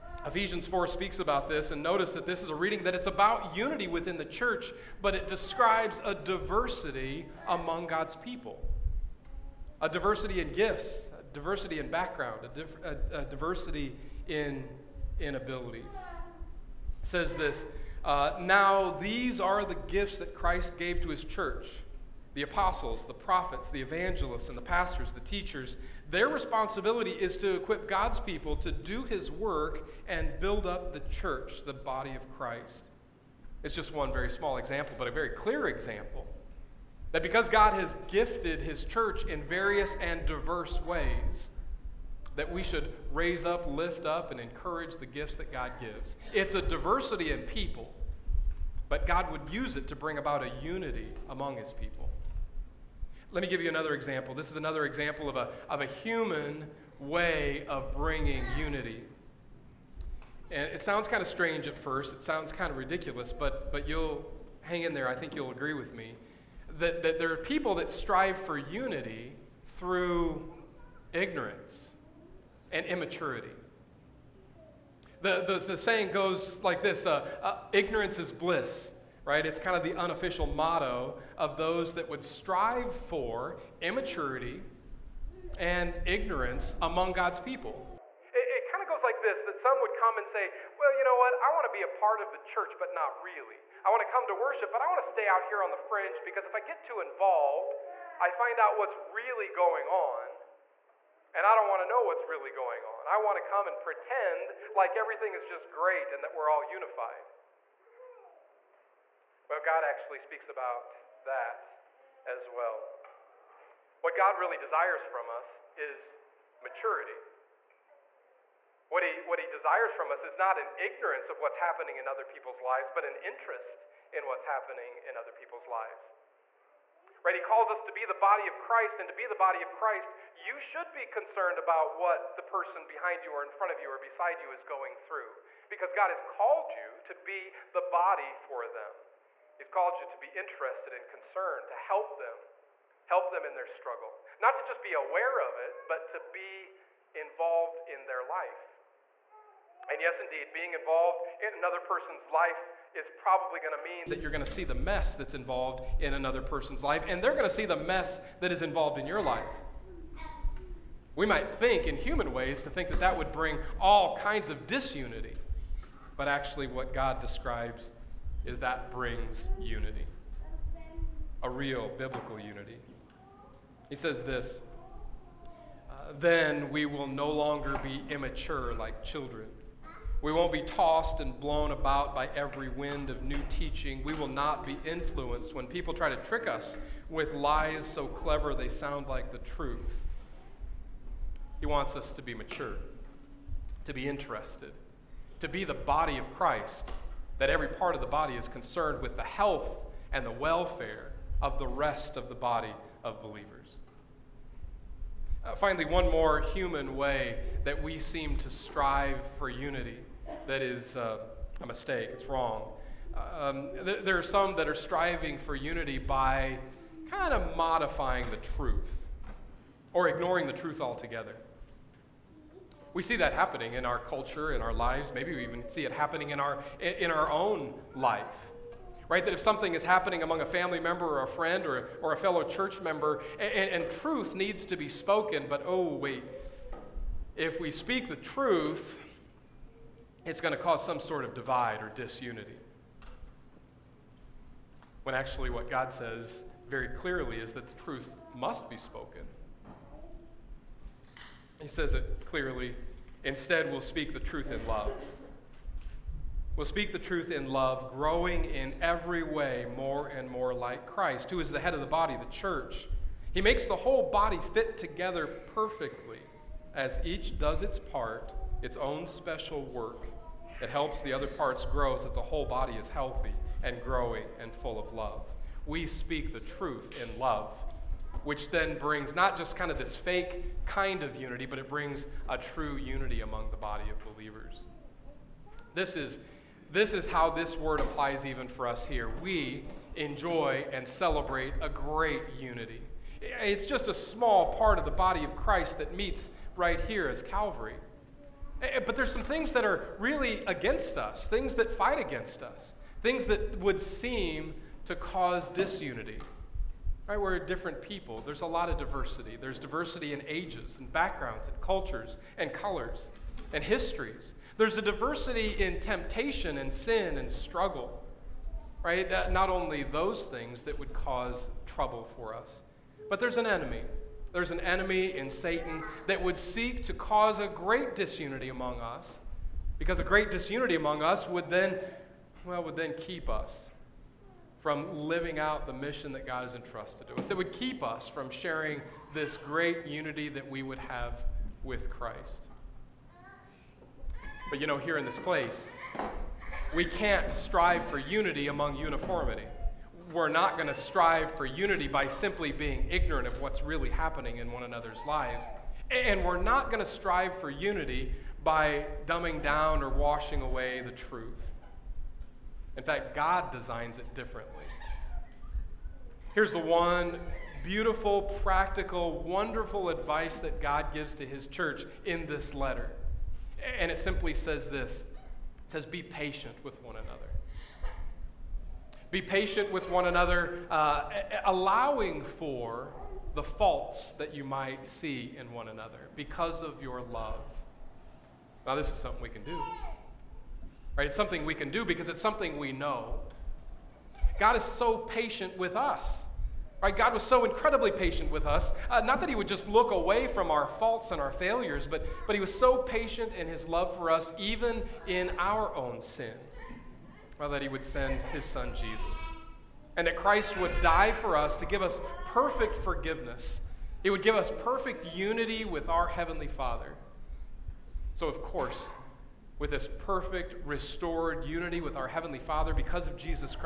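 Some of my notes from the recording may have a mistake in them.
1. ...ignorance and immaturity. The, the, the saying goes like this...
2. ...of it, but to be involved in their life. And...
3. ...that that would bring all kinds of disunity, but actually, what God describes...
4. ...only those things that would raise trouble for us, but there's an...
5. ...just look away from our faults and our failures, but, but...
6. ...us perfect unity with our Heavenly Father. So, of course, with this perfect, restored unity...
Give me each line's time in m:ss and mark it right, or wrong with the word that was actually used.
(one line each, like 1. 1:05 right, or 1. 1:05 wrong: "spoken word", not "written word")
1. 1:11 right
2. 2:25 right
3. 2:42 right
4. 5:19 wrong: "cause", not "raise"
5. 6:39 right
6. 6:54 right.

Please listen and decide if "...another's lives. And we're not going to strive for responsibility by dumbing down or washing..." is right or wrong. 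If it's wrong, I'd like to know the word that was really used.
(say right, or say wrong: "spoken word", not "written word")
wrong: "unity", not "responsibility".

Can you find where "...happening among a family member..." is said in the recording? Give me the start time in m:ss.
3:49.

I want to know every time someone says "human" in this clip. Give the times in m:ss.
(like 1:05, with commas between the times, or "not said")
0:55, 2:41, 3:26.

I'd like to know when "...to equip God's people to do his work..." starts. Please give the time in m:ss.
0:27.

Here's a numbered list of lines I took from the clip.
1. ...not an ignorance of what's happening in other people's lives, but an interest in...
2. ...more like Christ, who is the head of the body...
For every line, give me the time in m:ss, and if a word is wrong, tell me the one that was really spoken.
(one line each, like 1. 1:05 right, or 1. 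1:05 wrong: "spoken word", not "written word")
1. 2:00 right
2. 4:20 right.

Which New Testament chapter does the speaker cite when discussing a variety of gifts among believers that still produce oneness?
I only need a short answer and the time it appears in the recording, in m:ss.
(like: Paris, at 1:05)
Ephesians 4, at 0:00.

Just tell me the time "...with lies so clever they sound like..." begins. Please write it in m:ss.
3:07.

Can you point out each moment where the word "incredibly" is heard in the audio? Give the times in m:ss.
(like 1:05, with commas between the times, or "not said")
6:37.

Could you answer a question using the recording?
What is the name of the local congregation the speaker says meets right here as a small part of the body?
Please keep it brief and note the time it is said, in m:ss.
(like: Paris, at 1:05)
Calvary, at 4:57.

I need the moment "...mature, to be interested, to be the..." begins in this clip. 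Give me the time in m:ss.
3:12.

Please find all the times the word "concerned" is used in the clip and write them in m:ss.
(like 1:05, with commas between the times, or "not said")
2:11, 2:21, 3:18.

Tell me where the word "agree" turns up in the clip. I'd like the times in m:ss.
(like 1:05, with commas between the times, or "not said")
1:05.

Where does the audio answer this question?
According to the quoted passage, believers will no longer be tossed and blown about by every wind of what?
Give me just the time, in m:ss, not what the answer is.
3:03.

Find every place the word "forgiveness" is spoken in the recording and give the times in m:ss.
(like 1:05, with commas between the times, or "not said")
6:52.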